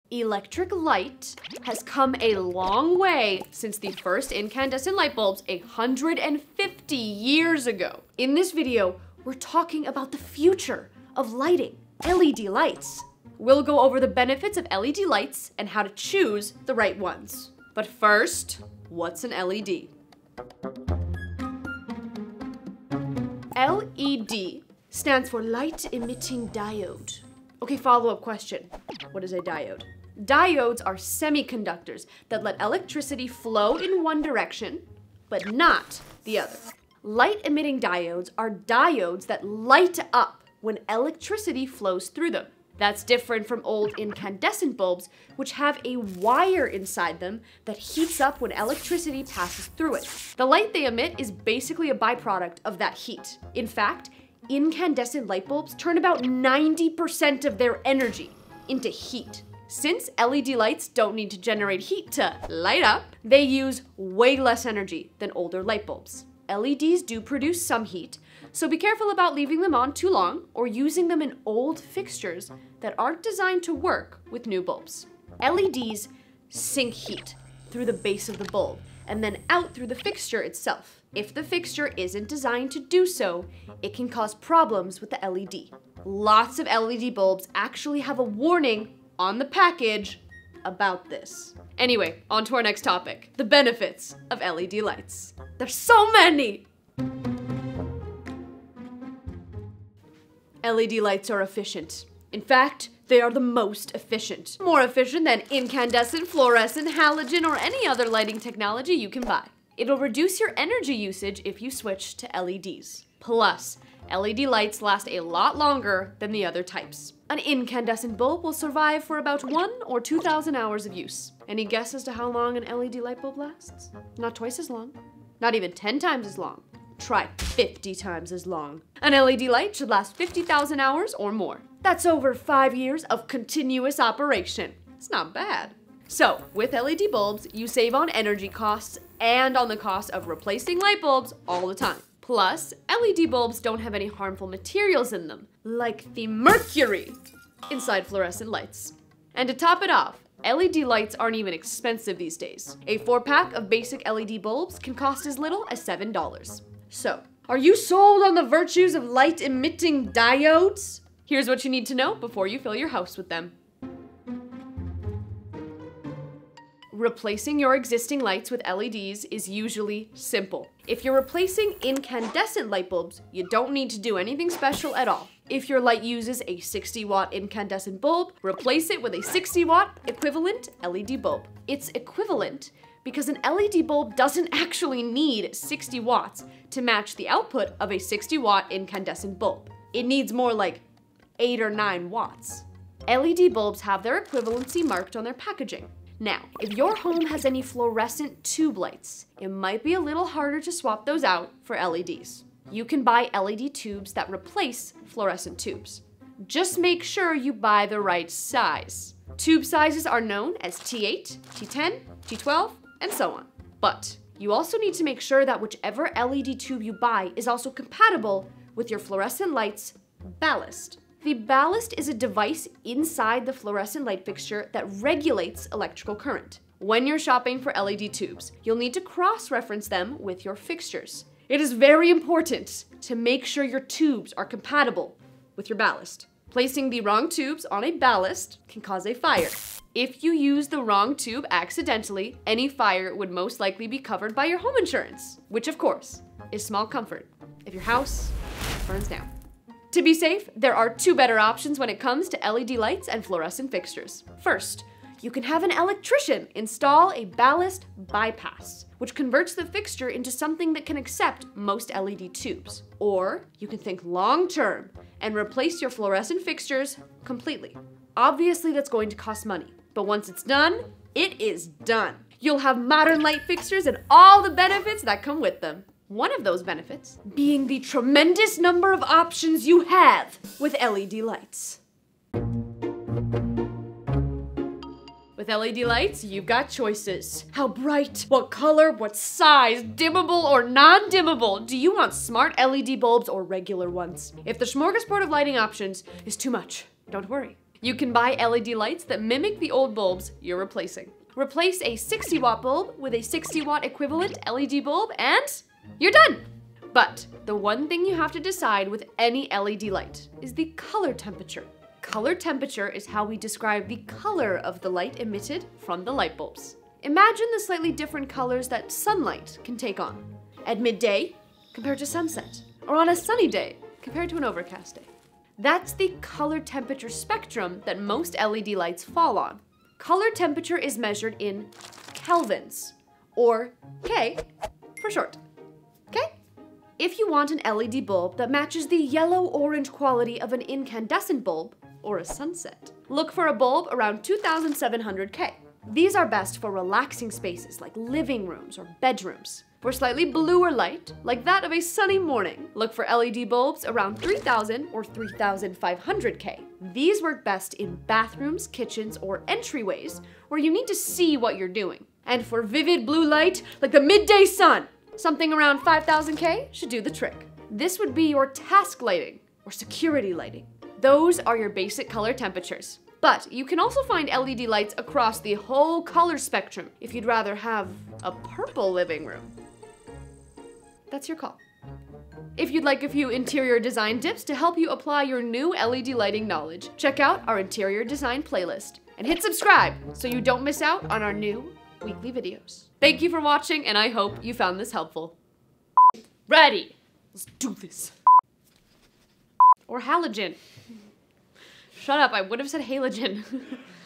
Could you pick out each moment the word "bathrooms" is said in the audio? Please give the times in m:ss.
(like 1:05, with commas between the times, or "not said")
5:58.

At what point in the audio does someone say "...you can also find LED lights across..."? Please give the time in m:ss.
6:13.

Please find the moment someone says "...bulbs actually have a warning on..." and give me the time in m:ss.
1:27.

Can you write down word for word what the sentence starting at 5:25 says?
That's the color temperature spectrum that most LED lights fall on.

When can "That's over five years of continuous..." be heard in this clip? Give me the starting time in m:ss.
2:11.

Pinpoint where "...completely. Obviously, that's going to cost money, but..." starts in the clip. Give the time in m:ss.
4:27.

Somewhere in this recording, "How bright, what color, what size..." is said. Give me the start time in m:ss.
4:47.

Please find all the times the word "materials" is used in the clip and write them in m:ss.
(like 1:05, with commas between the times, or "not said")
2:24.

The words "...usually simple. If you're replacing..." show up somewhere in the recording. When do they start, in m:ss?
2:49.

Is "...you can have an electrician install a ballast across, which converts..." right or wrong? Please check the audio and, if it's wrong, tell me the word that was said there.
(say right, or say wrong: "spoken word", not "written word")
wrong: "bypass", not "across".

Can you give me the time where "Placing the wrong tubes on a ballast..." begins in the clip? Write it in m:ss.
3:56.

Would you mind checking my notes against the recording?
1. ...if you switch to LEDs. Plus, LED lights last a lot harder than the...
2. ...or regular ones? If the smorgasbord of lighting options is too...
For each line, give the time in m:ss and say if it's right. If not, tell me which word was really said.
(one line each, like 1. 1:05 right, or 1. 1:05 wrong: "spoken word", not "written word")
1. 1:51 wrong: "longer", not "harder"
2. 4:53 right.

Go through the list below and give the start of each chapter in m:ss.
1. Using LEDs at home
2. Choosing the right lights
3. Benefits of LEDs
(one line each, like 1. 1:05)
1. 2:44
2. 4:42
3. 1:37.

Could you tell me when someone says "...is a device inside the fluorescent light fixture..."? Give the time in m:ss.
3:41.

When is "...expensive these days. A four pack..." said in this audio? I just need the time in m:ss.
2:31.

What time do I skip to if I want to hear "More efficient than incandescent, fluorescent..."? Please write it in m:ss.
1:44.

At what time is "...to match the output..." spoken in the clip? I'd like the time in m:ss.
3:06.